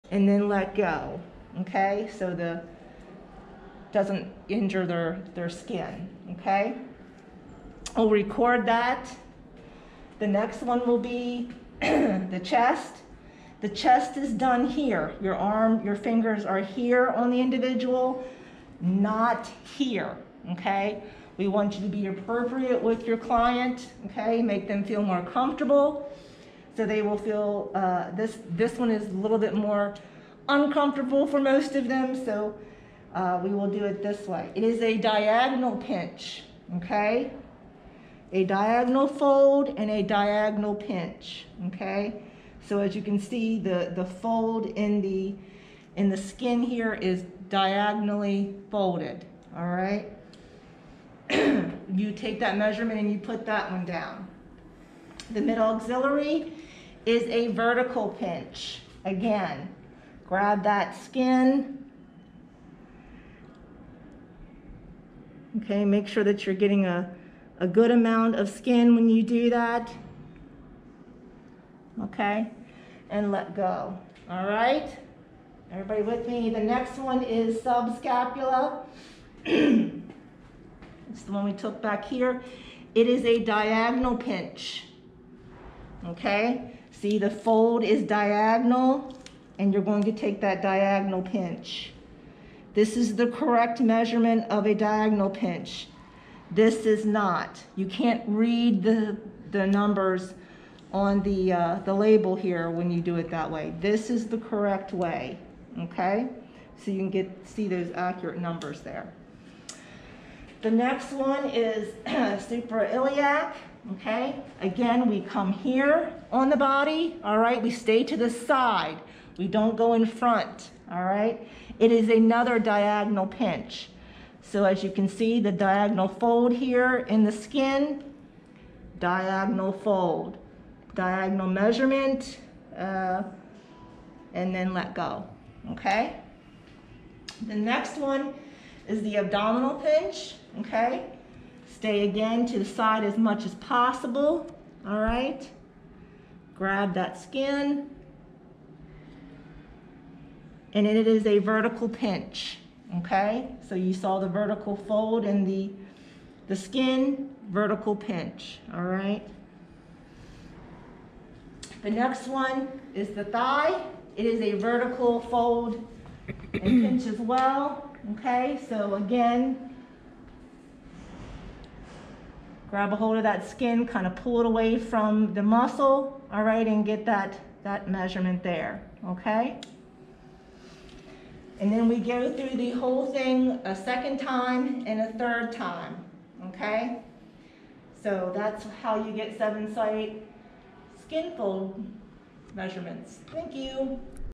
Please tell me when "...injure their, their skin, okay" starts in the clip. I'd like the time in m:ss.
0:04.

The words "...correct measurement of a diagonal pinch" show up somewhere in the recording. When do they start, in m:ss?
1:33.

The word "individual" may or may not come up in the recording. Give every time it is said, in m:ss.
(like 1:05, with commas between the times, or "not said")
0:17.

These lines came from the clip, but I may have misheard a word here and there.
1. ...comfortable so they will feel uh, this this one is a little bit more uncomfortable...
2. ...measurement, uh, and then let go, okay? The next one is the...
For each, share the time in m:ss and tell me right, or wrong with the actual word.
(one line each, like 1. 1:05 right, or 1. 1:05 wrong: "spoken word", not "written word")
1. 0:25 right
2. 2:11 right.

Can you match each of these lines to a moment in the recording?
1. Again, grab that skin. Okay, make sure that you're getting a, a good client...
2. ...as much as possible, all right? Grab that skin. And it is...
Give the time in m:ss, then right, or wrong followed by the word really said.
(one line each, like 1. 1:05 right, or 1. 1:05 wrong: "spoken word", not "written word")
1. 0:59 wrong: "amount", not "client"
2. 2:23 right.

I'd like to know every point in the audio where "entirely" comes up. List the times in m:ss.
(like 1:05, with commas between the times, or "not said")
not said.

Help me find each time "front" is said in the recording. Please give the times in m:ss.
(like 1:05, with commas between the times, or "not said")
2:00.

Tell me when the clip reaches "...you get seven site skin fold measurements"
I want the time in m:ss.
3:09.